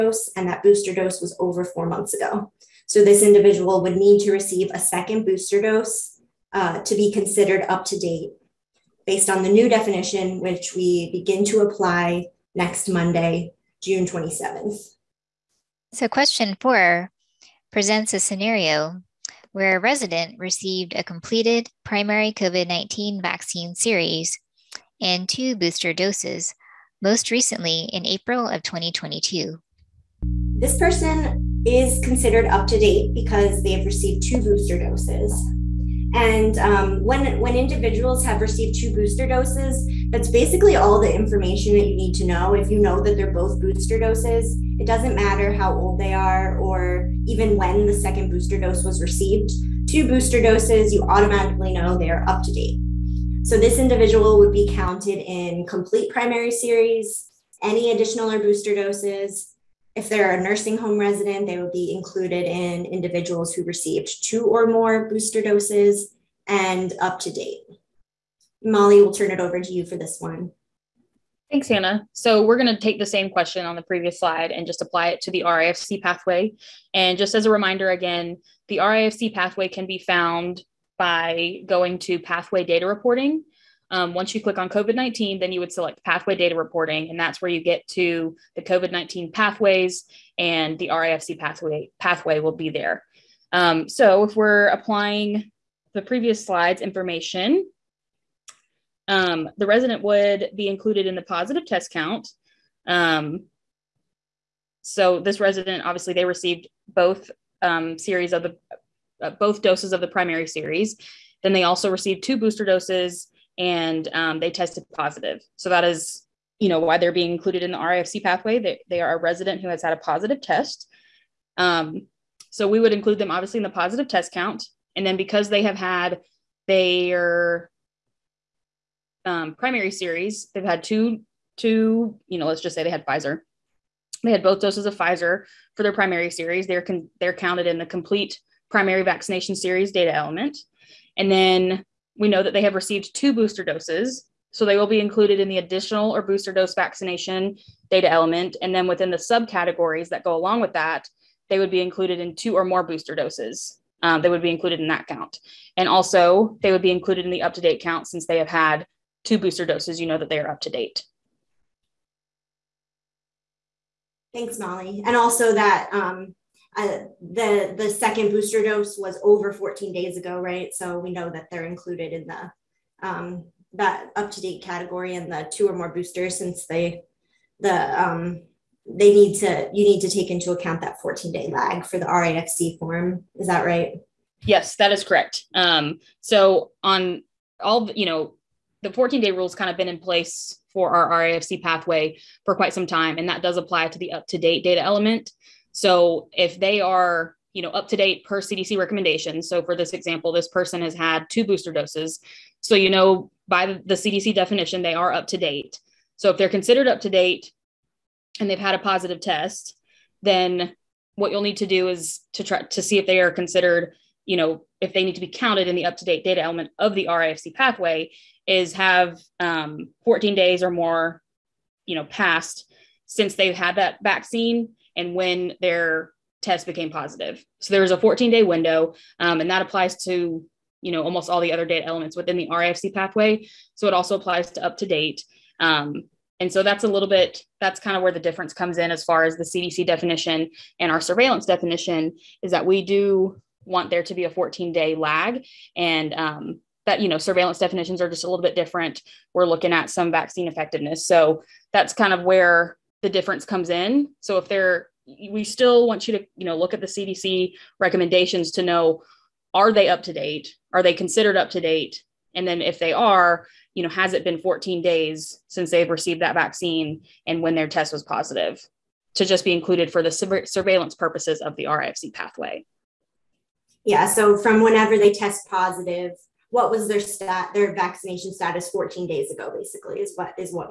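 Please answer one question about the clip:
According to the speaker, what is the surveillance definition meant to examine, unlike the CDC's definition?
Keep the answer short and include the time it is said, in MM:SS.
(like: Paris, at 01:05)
vaccine effectiveness, at 04:10.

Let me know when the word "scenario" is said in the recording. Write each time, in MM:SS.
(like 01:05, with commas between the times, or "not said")
00:18.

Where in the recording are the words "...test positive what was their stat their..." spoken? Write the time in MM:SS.
04:35.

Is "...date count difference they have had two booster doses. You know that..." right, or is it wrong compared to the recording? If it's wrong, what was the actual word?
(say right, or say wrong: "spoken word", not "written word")
wrong: "since", not "difference".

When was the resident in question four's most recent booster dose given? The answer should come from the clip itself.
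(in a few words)
April of 2022.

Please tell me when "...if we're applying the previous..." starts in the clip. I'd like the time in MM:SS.
01:34.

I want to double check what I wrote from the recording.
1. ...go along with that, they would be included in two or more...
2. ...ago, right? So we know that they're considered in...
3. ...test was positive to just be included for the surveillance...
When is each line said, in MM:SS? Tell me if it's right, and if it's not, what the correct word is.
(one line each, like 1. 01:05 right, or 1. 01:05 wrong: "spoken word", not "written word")
1. 02:30 right
2. 02:50 wrong: "included", not "considered"
3. 04:27 right.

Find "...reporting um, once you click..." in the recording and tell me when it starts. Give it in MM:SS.
01:22.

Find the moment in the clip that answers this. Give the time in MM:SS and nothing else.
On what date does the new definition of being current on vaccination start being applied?
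00:12.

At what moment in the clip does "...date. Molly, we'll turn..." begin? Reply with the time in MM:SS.
01:07.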